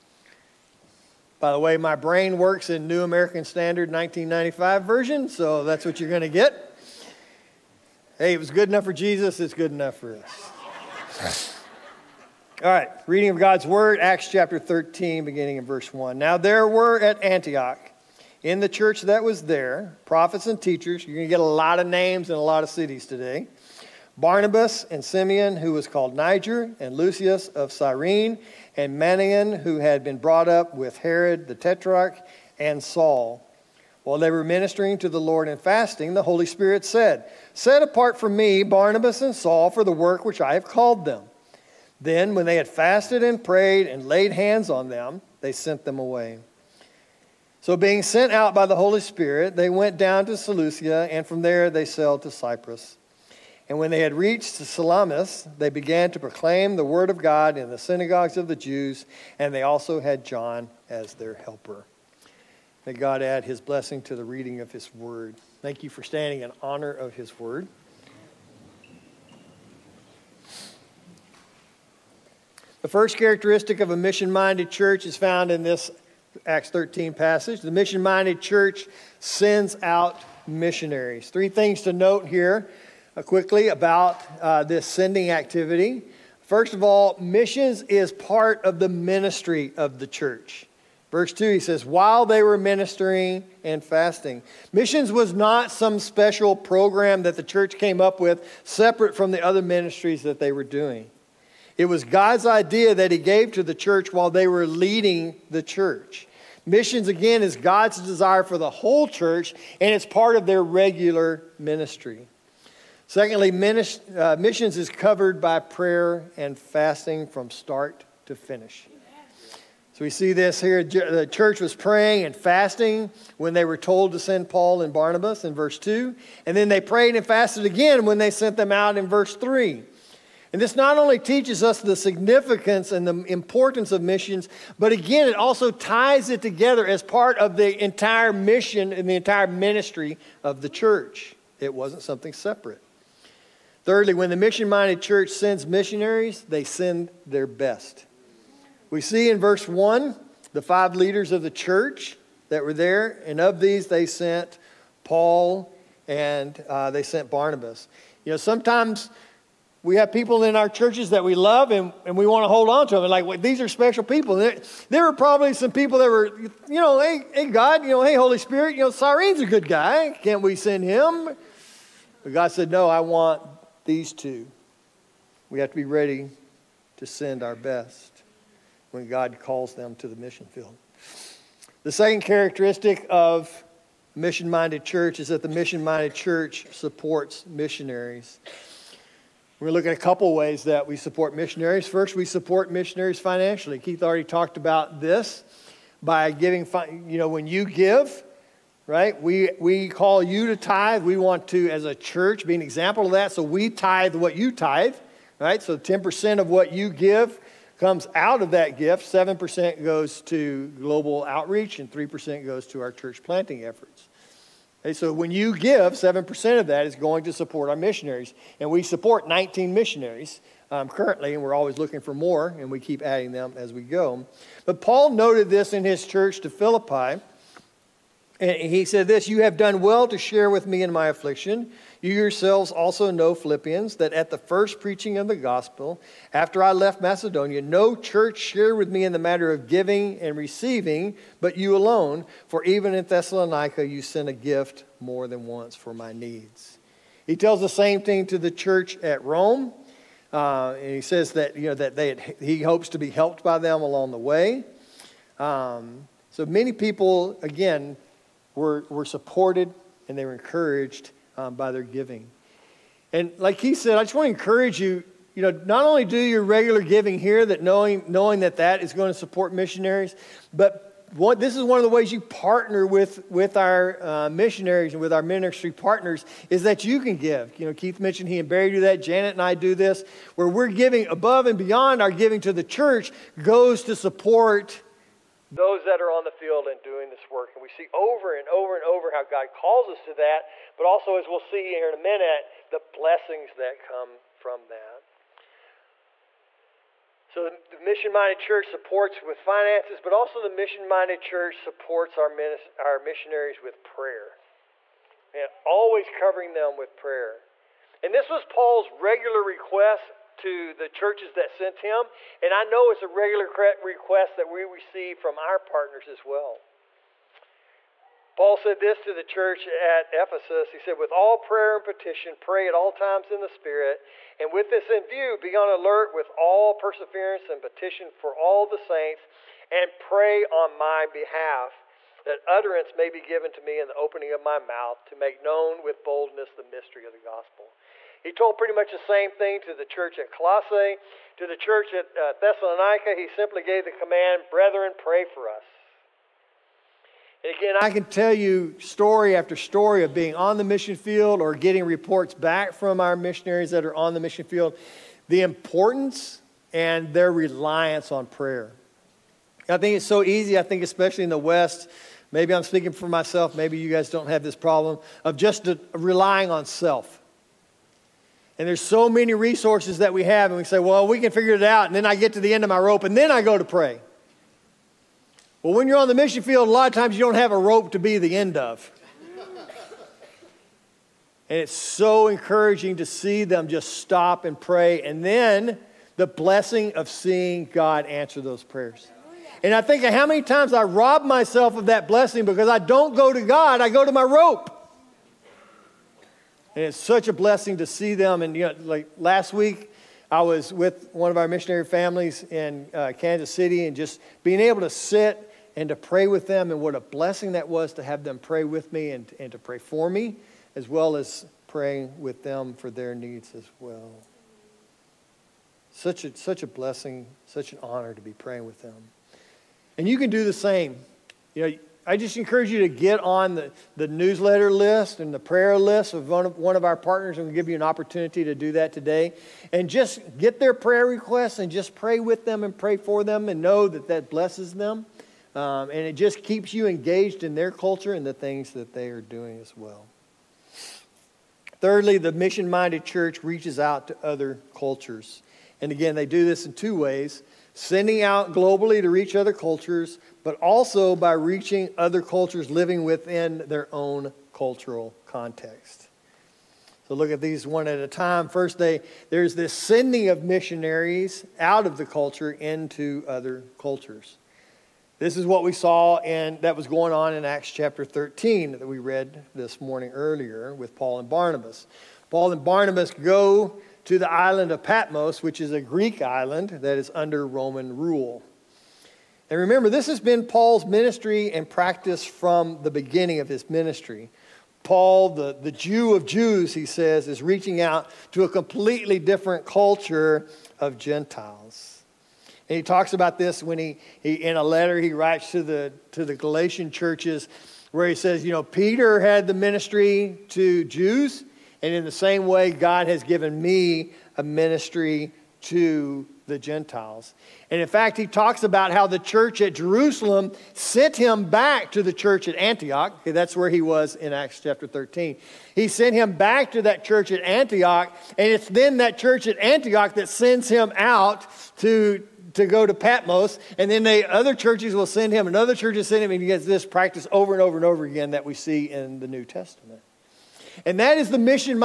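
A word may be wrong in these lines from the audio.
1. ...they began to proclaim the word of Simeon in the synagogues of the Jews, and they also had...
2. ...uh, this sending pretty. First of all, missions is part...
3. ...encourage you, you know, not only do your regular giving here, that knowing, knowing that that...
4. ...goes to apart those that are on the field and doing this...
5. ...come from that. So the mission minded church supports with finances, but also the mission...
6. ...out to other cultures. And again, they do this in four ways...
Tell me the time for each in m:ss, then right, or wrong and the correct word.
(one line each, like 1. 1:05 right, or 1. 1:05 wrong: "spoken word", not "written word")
1. 0:55 wrong: "God", not "Simeon"
2. 1:24 wrong: "activity", not "pretty"
3. 4:24 right
4. 4:43 wrong: "support", not "apart"
5. 4:53 right
6. 7:23 wrong: "two", not "four".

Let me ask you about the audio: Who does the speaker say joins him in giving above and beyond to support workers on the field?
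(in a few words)
Janet.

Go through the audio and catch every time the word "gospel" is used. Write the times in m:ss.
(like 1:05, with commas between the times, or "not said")
3:55, 5:37.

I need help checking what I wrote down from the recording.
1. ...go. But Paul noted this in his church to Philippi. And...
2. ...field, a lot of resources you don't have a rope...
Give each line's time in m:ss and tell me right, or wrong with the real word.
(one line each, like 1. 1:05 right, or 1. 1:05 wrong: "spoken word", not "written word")
1. 3:43 right
2. 6:16 wrong: "times", not "resources".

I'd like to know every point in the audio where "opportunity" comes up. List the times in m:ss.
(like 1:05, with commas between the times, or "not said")
7:07.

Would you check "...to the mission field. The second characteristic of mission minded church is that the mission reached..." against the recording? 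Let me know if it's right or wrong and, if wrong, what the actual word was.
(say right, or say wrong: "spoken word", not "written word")
wrong: "minded", not "reached".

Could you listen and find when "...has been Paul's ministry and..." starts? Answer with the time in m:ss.
8:00.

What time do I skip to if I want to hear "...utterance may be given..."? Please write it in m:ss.
5:32.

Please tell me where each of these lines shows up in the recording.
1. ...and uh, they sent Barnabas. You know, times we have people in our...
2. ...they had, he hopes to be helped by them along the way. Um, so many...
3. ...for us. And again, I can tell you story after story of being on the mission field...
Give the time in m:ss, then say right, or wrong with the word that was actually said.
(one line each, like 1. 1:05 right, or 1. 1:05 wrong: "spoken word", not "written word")
1. 2:36 wrong: "sometimes", not "times"
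2. 4:11 right
3. 5:45 right.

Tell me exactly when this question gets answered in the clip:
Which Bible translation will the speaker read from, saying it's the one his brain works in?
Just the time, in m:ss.
0:02.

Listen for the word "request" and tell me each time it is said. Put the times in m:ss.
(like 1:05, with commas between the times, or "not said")
5:09, 5:13, 7:11.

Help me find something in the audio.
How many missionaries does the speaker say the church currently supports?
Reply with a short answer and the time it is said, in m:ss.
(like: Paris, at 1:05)
19, at 3:39.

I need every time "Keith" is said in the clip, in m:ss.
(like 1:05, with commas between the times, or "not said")
3:13, 4:37.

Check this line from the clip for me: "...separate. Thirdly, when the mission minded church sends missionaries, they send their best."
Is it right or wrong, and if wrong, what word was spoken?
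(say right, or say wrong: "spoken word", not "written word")
right.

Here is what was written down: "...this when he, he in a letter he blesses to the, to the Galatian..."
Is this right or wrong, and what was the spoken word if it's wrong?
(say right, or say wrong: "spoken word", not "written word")
wrong: "writes", not "blesses".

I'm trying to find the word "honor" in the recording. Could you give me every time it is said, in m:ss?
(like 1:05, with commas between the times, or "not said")
1:06, 6:57.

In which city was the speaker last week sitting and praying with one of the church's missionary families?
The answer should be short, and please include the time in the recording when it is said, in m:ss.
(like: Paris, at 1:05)
Kansas City, at 6:43.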